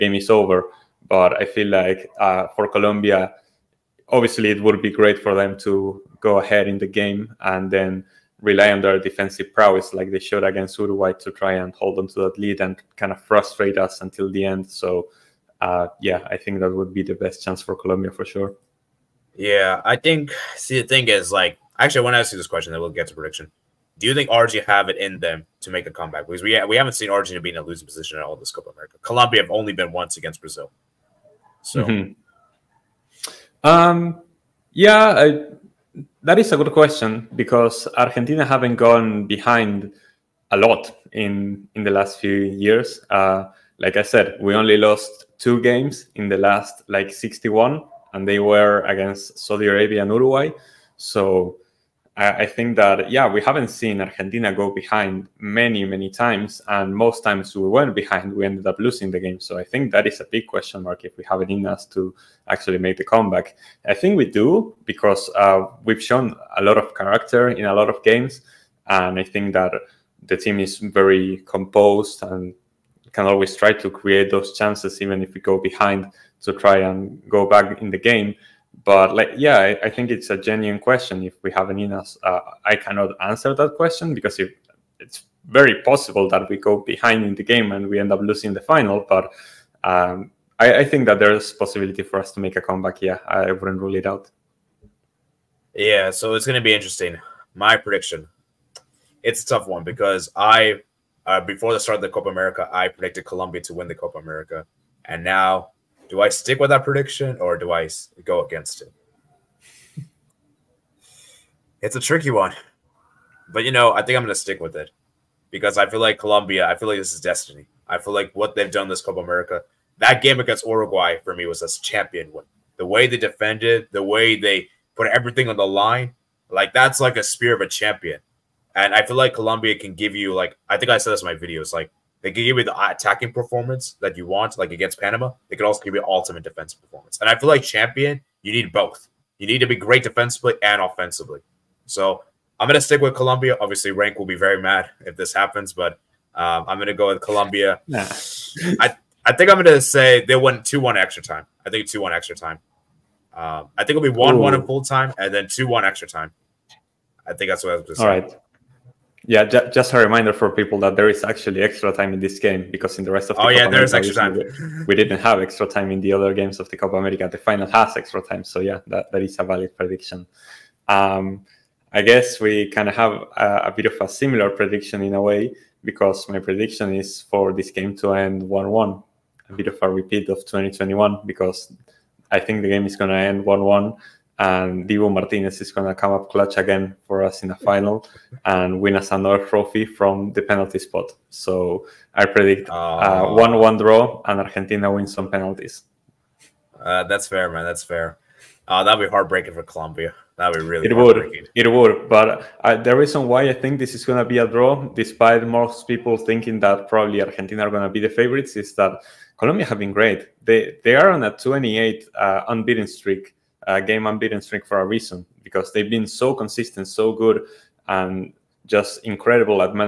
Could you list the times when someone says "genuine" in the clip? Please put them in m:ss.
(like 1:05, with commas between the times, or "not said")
1:20.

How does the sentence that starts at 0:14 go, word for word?
So uh, yeah, I think that would be the best chance for Colombia for sure.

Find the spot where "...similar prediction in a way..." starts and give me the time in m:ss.
2:54.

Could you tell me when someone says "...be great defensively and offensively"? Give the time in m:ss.
2:19.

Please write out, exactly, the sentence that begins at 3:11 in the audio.
So I predict uh, one-one draw and Argentina wins some penalties.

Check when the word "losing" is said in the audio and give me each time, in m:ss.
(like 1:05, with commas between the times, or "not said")
0:27, 0:58, 1:28.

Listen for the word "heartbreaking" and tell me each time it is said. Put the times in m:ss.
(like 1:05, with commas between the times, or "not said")
3:19.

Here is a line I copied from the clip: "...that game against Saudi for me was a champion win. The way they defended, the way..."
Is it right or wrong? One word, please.
wrong.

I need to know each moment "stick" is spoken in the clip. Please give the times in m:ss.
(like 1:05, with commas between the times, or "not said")
1:46, 1:54, 2:22.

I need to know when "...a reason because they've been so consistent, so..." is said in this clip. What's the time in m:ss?
3:34.